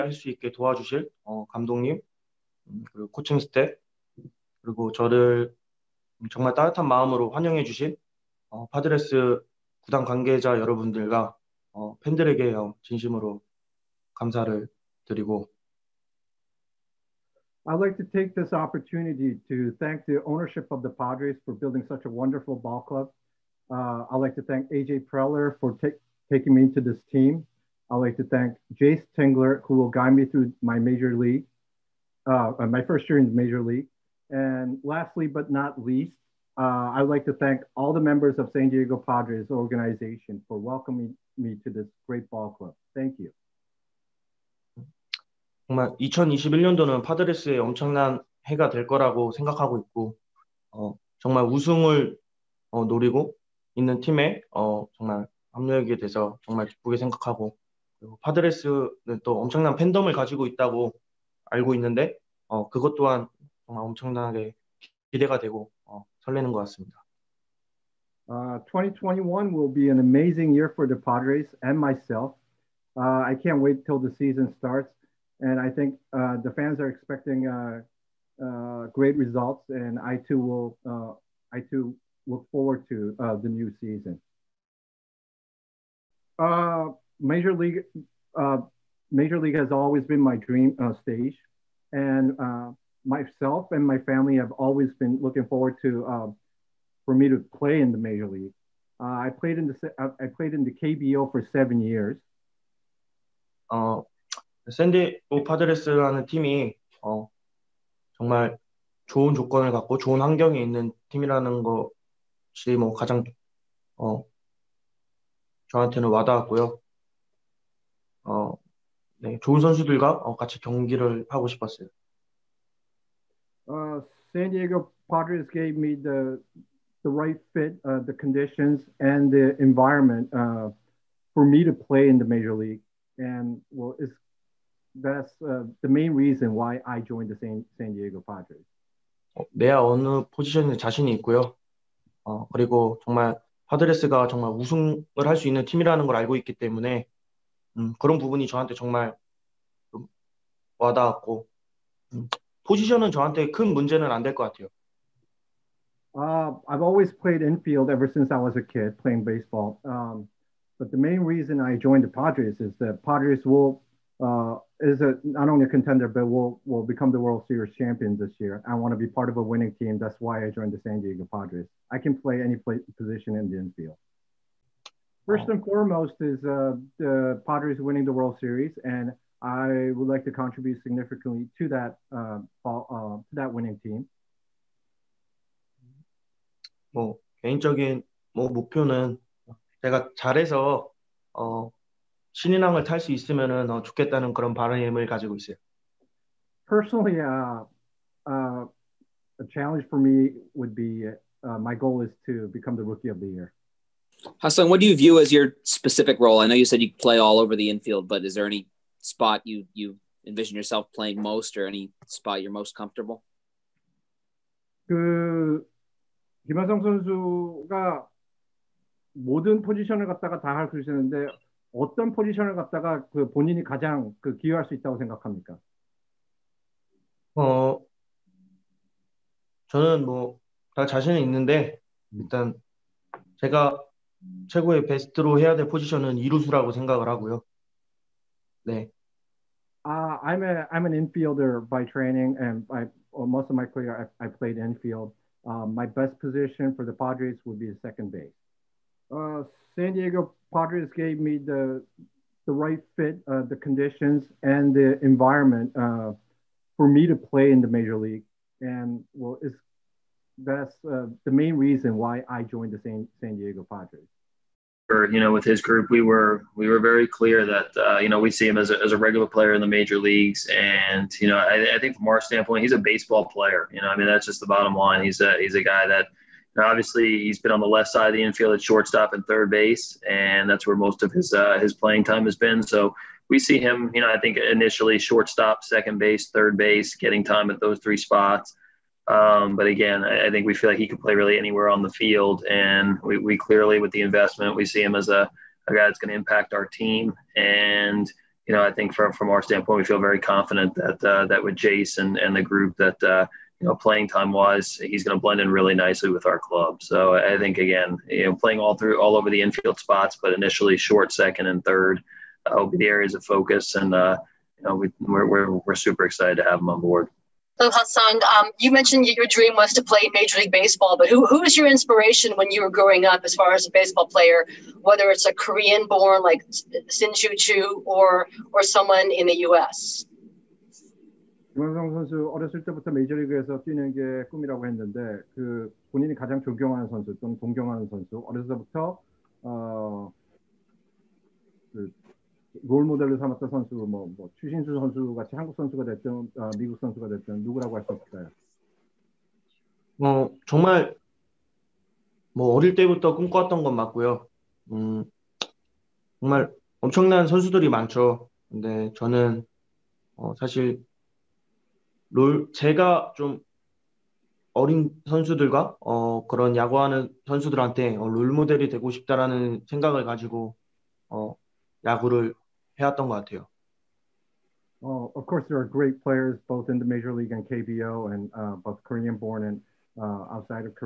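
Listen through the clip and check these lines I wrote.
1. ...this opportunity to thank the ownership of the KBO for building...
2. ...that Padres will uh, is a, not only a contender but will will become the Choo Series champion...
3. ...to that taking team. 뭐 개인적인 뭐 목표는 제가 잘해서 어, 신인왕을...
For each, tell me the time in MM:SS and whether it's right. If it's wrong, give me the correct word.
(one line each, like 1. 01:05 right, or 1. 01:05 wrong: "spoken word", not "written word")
1. 00:18 wrong: "Padres", not "KBO"
2. 02:42 wrong: "World", not "Choo"
3. 03:02 wrong: "winning", not "taking".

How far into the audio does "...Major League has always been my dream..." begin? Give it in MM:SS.
01:29.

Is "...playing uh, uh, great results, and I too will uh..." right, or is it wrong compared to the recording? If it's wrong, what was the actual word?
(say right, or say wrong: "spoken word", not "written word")
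wrong: "expecting", not "playing".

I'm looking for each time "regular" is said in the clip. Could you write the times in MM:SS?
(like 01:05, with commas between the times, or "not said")
04:28.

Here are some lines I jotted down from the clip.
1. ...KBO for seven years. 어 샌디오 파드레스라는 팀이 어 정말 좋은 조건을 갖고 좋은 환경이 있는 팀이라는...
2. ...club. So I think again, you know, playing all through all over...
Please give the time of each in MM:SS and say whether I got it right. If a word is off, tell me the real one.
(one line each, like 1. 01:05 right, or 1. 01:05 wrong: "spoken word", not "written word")
1. 01:40 right
2. 05:06 right.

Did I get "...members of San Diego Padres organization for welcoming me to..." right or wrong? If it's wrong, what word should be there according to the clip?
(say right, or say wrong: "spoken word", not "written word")
right.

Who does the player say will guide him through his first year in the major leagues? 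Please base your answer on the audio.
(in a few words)
Jace Tingler.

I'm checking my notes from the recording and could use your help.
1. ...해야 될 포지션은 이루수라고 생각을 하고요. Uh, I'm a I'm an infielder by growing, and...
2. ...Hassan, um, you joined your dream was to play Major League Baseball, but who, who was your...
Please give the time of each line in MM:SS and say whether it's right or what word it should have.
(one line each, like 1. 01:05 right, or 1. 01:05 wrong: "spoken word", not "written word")
1. 03:55 wrong: "training", not "growing"
2. 05:17 wrong: "mentioned", not "joined".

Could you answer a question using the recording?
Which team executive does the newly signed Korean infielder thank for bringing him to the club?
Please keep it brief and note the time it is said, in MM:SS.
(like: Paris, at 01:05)
AJ Preller, at 00:24.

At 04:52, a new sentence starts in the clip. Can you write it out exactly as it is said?
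And we, we clearly, with the investment, we see him as a, a guy that's going to impact our team.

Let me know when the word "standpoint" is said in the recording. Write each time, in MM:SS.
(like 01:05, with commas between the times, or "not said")
04:32, 04:59.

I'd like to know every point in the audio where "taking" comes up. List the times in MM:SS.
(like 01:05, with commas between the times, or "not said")
00:26.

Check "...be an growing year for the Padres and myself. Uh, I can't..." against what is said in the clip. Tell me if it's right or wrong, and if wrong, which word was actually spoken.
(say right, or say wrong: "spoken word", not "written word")
wrong: "amazing", not "growing".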